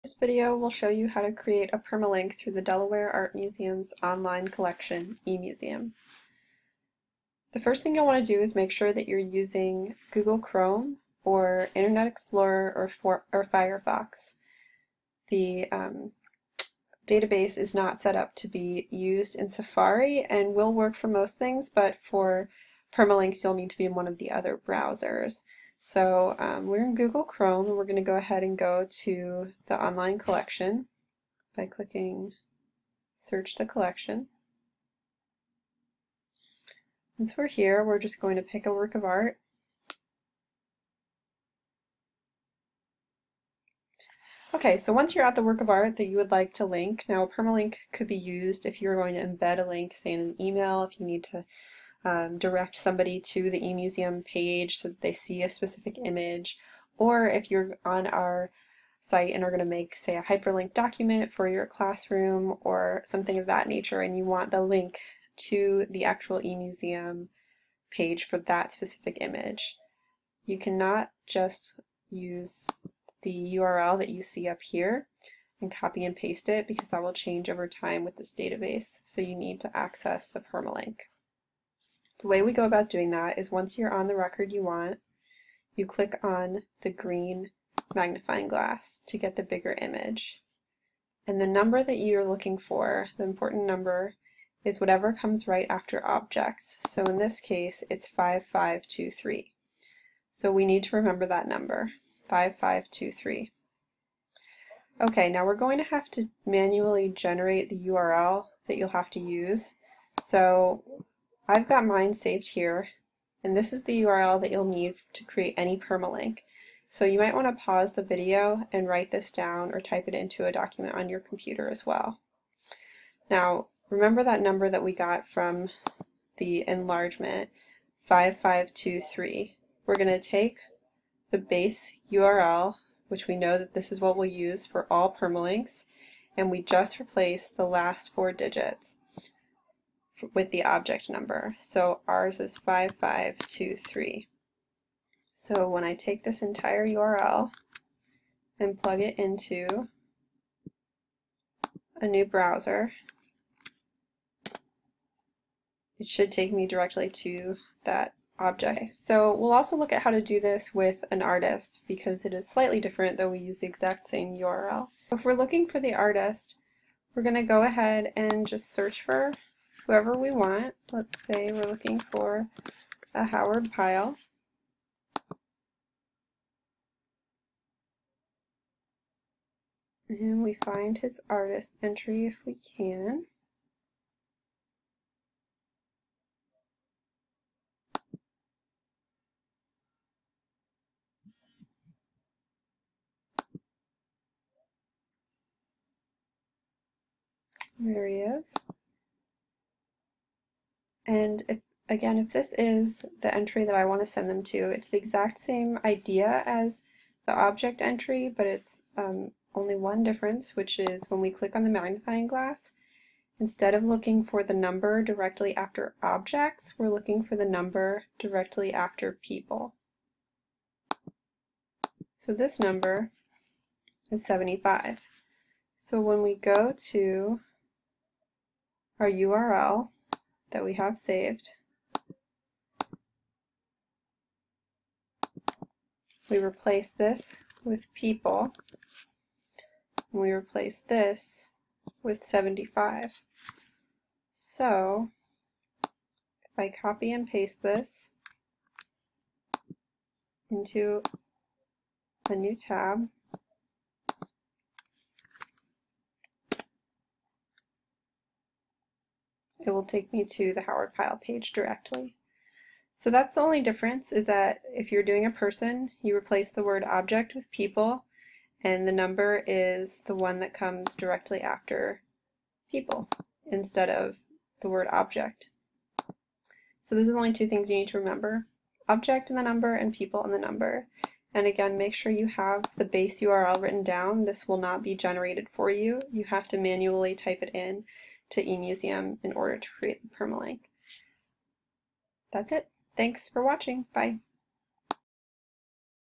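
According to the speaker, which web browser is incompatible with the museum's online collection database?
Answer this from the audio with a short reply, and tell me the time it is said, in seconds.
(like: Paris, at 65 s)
Safari, at 19 s.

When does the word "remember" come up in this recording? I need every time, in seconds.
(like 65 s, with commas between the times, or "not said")
100 s, 123 s, 277 s.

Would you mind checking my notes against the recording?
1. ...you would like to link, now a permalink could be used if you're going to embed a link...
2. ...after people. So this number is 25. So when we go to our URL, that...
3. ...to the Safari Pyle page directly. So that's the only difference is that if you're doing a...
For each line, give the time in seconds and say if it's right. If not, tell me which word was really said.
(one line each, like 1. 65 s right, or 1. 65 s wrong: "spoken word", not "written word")
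1. 46 s right
2. 218 s wrong: "75", not "25"
3. 260 s wrong: "Howard", not "Safari".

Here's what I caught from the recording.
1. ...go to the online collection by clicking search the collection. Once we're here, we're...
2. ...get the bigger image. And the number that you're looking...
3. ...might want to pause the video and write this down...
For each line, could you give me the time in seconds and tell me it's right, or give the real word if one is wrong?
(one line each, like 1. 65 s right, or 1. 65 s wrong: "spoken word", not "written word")
1. 28 s right
2. 89 s right
3. 117 s right.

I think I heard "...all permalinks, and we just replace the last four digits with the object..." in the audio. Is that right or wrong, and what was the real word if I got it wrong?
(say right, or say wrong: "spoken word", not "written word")
right.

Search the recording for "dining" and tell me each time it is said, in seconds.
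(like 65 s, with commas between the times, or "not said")
not said.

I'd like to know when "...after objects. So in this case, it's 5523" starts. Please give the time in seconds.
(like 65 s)
95 s.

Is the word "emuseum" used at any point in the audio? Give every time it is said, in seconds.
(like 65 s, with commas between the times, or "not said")
5 s, 53 s, 66 s, 288 s.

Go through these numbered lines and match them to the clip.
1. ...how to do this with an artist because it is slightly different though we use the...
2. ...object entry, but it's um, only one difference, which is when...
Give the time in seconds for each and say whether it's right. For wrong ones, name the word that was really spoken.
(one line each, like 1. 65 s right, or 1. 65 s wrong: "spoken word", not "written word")
1. 160 s right
2. 207 s right.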